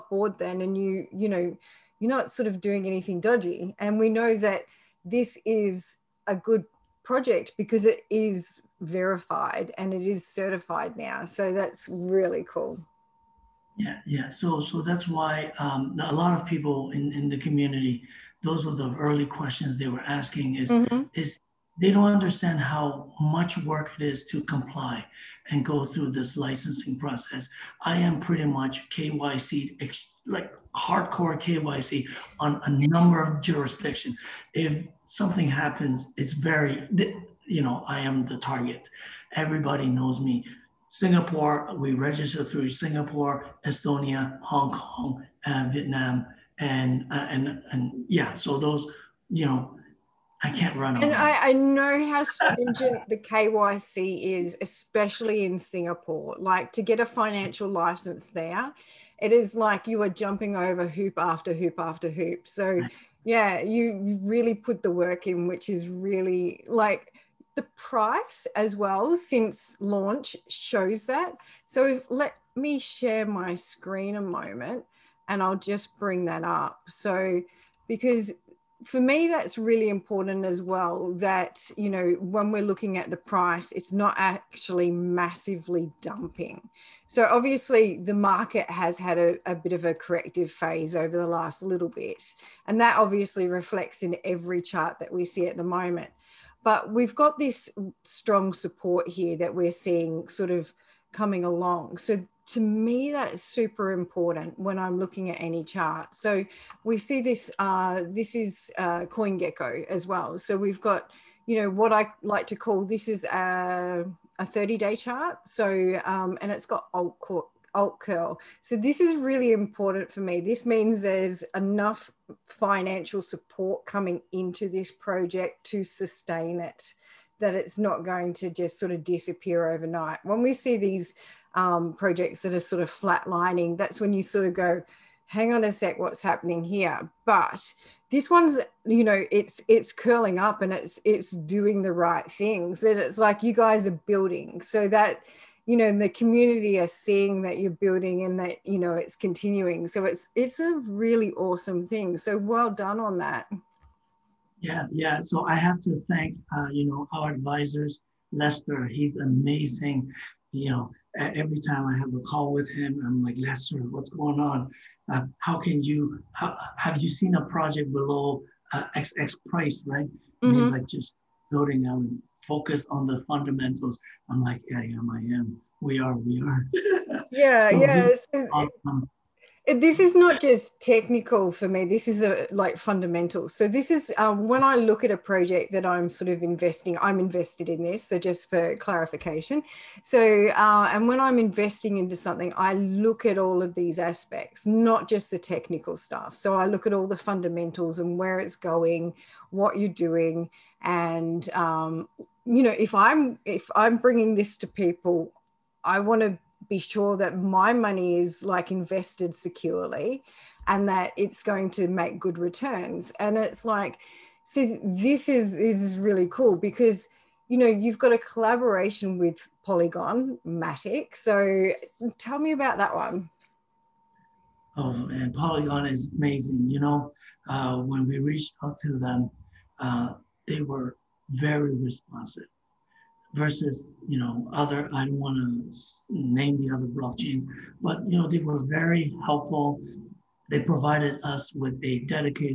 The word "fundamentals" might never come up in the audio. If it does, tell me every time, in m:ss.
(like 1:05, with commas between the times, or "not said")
2:53, 3:02, 3:17.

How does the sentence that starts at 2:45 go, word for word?
Uh, how can you, how, have you seen a project below uh, X, X price, right?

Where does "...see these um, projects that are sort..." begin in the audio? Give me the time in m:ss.
2:10.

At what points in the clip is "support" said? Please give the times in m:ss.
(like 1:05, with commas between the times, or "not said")
1:38, 2:03.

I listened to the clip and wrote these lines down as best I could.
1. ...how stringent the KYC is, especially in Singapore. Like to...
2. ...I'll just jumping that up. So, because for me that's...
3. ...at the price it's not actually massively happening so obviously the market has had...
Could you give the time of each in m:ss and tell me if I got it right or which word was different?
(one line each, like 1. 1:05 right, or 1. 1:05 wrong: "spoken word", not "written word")
1. 0:52 right
2. 1:15 wrong: "bring", not "jumping"
3. 1:22 wrong: "dumping", not "happening".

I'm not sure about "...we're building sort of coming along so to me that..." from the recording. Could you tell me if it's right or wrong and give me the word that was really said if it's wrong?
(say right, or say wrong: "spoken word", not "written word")
wrong: "seeing", not "building".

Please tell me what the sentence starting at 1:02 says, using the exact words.
So, yeah, you really put the work in, which is really like the price as well since launch shows that.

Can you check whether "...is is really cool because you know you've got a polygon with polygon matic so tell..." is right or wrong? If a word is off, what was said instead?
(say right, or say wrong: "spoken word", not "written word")
wrong: "collaboration", not "polygon".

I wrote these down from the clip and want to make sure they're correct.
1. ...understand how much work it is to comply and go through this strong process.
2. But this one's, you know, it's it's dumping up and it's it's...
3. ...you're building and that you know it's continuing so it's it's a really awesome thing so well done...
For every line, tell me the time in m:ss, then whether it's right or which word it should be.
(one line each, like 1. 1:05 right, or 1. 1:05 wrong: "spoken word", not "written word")
1. 0:22 wrong: "licensing", not "strong"
2. 2:17 wrong: "curling", not "dumping"
3. 2:27 right.